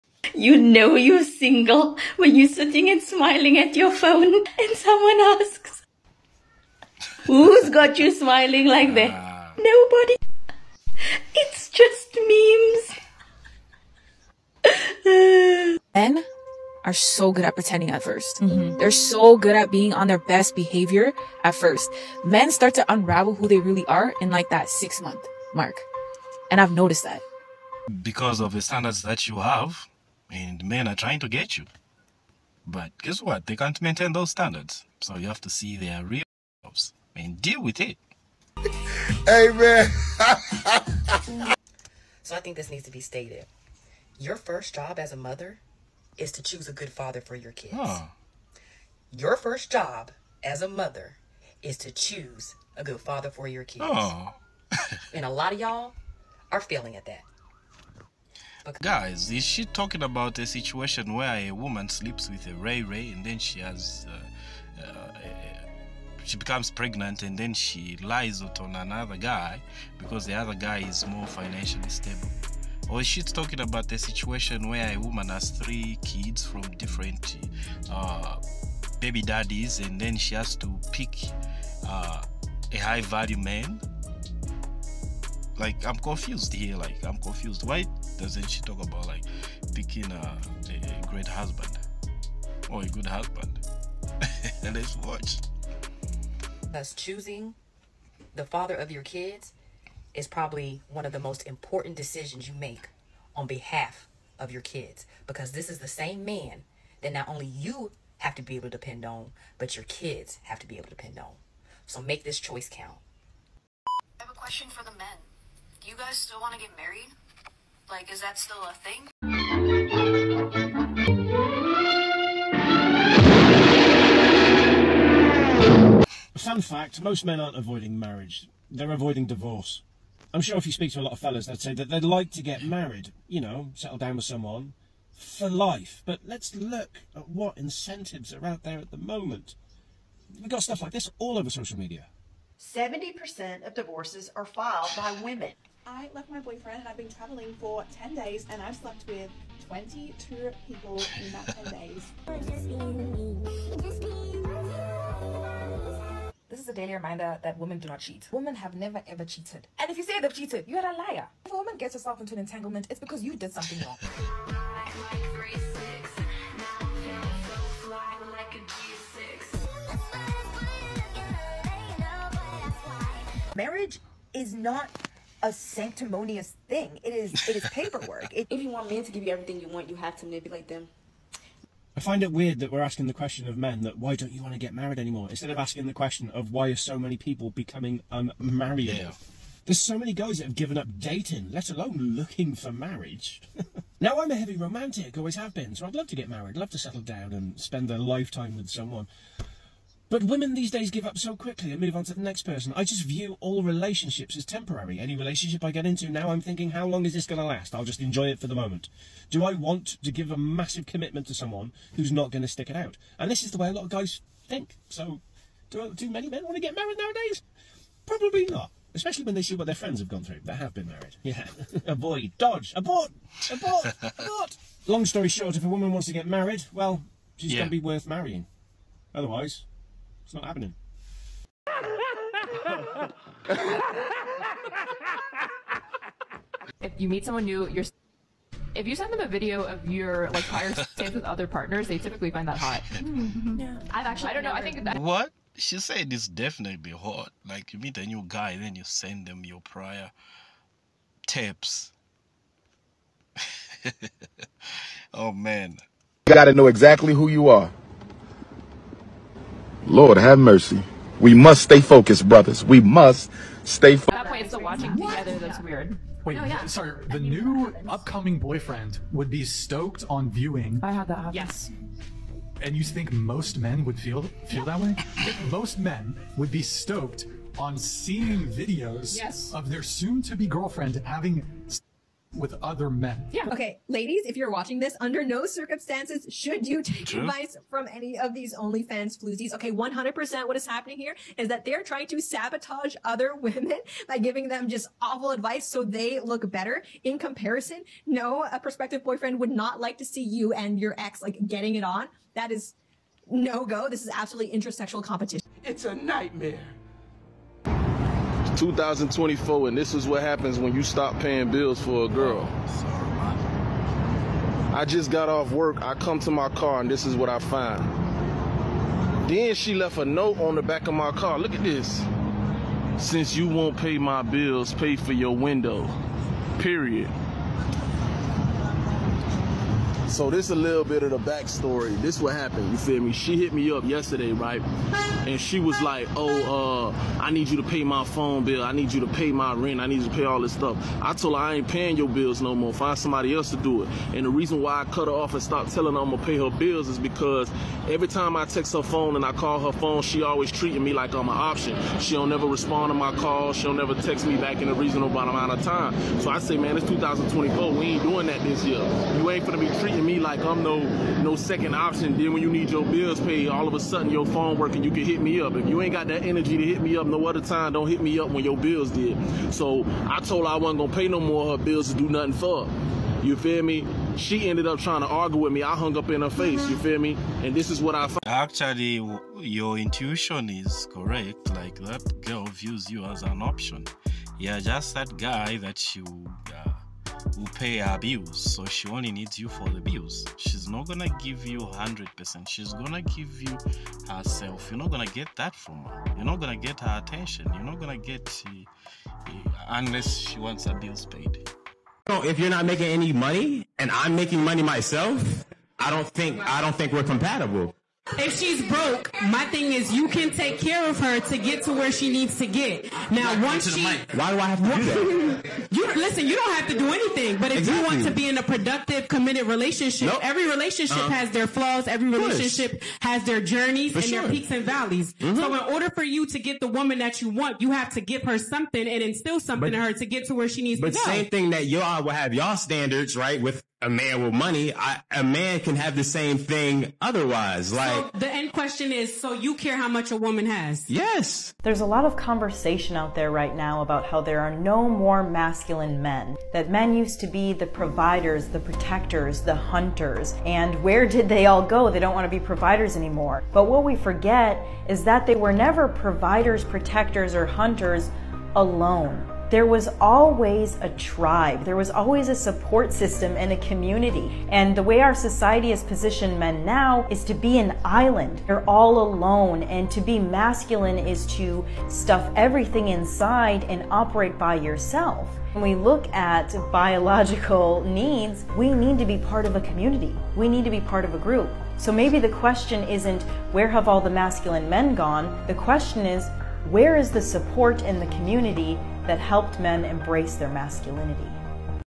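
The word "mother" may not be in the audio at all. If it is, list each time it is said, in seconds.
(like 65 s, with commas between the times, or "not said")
45 s, 50 s.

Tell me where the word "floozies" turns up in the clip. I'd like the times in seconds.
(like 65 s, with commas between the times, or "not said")
289 s.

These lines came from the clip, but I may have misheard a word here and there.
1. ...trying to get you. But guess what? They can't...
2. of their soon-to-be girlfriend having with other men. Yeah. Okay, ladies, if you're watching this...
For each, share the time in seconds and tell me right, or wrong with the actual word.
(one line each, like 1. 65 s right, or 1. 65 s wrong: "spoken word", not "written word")
1. 30 s right
2. 279 s right.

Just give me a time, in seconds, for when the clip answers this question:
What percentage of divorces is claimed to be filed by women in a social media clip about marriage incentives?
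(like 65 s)
142 s.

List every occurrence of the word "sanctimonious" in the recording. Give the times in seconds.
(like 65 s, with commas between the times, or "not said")
175 s.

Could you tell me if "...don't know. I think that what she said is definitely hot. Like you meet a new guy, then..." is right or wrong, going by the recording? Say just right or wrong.
right.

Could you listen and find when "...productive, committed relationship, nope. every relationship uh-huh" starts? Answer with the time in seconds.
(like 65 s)
418 s.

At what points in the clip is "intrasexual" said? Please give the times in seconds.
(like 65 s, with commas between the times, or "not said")
304 s.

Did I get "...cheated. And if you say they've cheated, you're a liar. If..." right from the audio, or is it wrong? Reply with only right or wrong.
right.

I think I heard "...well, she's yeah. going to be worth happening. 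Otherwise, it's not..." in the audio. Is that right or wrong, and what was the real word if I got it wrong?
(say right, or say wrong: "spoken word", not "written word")
wrong: "marrying", not "happening".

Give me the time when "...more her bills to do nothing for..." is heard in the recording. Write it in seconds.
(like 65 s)
371 s.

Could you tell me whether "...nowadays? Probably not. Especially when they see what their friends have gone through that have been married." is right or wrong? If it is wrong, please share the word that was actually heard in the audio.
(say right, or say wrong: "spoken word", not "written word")
right.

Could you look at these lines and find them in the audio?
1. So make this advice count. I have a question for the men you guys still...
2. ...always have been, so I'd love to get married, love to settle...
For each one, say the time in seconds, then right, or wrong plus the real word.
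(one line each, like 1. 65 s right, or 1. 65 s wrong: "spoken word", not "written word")
1. 111 s wrong: "choice", not "advice"
2. 195 s right.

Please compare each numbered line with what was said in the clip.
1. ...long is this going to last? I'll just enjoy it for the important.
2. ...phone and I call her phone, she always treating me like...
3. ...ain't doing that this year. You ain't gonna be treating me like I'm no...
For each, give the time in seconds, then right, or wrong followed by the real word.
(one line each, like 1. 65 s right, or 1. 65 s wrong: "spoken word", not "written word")
1. 206 s wrong: "moment", not "important"
2. 348 s right
3. 357 s right.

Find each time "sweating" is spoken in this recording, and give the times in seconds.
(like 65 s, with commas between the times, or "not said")
not said.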